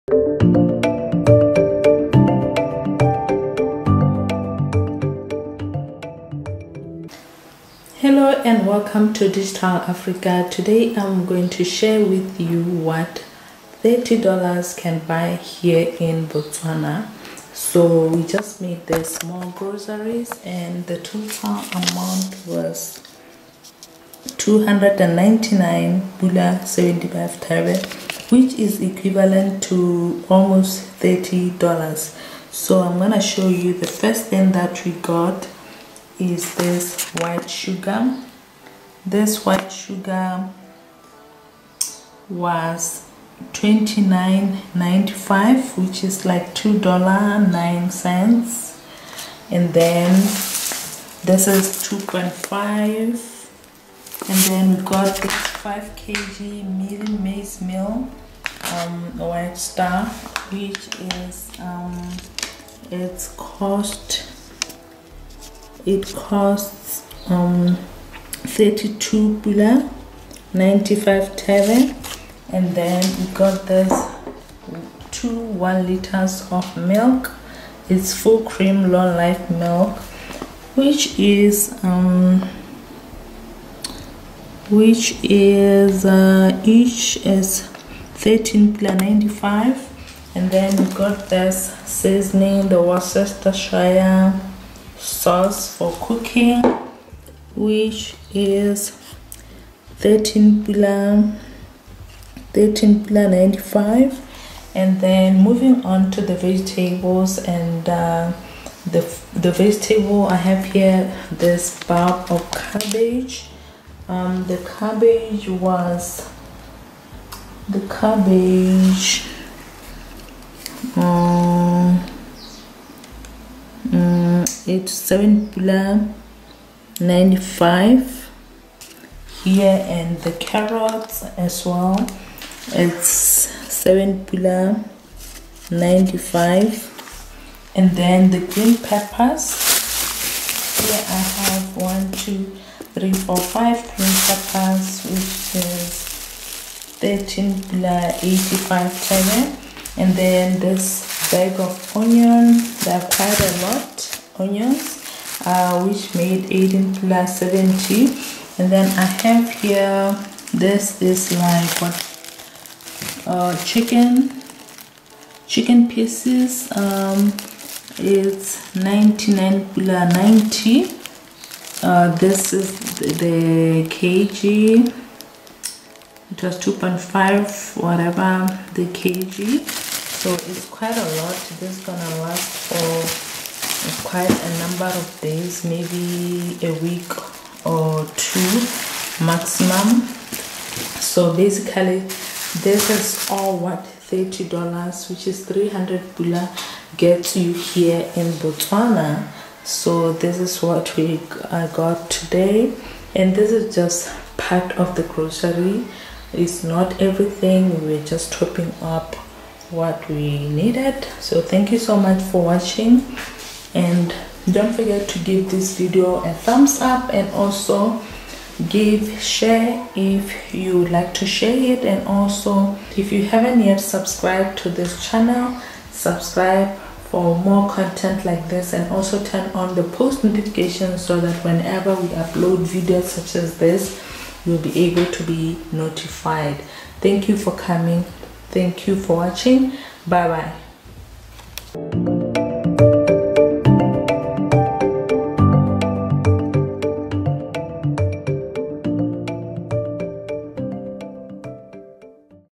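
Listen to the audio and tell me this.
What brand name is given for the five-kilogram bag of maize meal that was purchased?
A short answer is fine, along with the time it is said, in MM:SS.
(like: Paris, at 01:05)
White Star, at 00:59.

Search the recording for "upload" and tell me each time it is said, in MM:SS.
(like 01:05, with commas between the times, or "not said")
03:52.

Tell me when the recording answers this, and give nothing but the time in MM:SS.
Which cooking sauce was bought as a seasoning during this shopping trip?
01:32.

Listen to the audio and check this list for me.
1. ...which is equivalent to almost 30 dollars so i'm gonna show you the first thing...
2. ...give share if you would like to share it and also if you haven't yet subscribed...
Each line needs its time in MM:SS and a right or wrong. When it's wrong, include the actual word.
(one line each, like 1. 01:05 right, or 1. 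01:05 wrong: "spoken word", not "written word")
1. 00:28 right
2. 03:38 right.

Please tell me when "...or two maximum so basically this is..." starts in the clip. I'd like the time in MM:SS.
03:07.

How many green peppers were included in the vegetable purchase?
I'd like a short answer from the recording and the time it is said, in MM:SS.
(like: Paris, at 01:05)
5, at 02:23.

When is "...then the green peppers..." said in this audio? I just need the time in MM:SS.
02:17.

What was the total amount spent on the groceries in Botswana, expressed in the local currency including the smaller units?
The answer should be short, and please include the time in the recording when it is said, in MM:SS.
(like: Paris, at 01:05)
299 pula 75 thebe, at 00:24.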